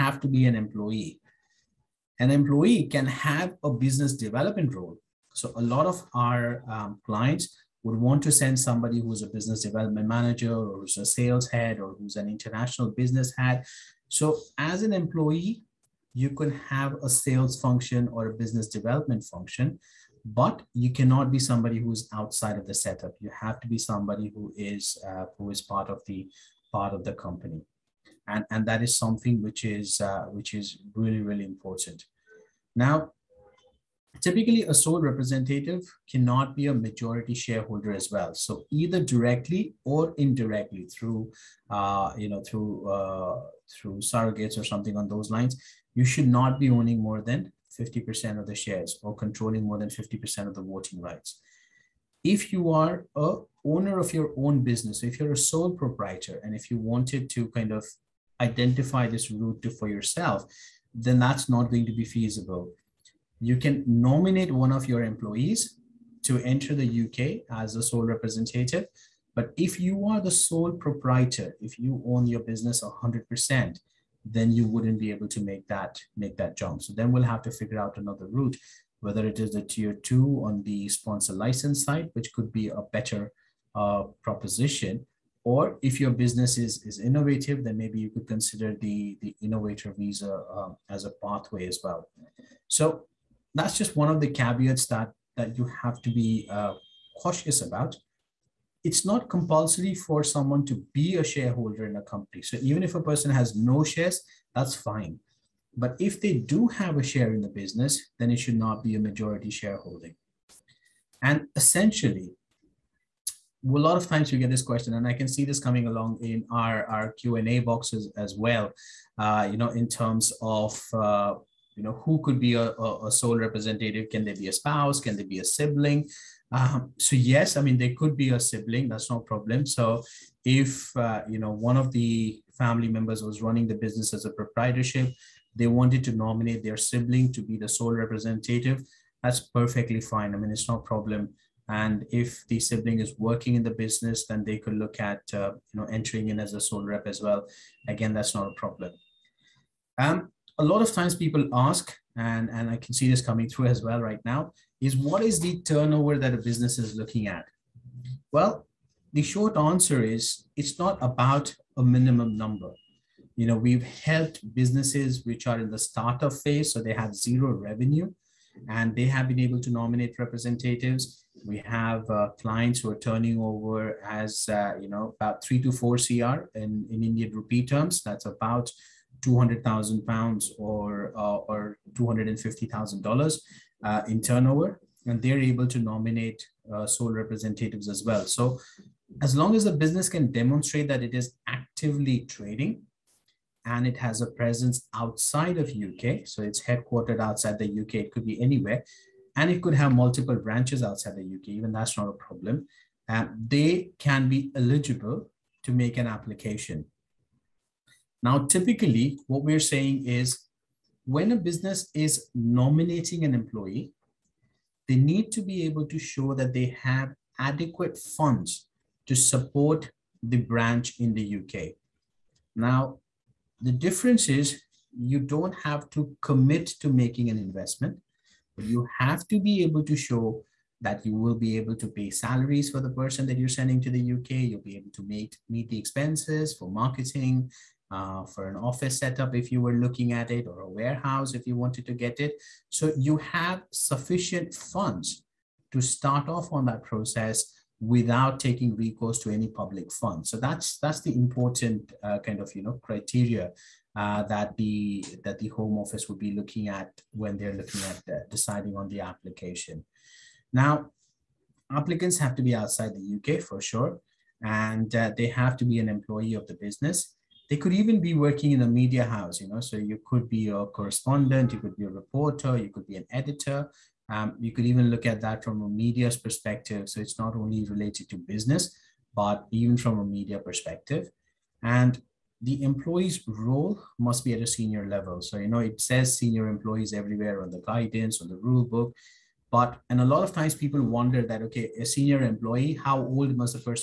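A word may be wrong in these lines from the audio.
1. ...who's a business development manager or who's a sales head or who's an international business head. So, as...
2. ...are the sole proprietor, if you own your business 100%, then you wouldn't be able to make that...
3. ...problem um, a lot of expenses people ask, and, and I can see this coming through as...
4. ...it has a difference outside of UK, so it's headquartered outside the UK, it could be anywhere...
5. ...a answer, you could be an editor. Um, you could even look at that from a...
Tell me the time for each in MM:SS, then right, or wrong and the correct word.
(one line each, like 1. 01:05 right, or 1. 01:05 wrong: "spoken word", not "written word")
1. 00:09 right
2. 01:10 right
3. 02:28 wrong: "times", not "expenses"
4. 03:13 wrong: "presence", not "difference"
5. 04:31 wrong: "reporter", not "answer".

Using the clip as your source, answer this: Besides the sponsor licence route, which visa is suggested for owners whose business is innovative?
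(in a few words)
Innovator visa.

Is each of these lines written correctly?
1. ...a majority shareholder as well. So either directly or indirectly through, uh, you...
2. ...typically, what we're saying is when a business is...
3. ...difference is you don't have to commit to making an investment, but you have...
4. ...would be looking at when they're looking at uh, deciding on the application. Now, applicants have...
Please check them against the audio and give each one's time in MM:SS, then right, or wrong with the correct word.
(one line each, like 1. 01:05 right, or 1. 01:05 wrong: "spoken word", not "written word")
1. 00:36 right
2. 03:28 right
3. 03:43 right
4. 04:16 right.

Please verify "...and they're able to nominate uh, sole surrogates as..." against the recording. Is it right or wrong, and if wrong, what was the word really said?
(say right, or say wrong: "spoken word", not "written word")
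wrong: "representatives", not "surrogates".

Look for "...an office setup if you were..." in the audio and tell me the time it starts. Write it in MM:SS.
03:58.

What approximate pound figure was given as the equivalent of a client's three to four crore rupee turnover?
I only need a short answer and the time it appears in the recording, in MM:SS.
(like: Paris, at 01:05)
200,000 pounds, at 02:59.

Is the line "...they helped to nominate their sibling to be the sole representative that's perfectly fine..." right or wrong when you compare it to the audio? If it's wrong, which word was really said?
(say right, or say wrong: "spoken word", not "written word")
wrong: "wanted", not "helped".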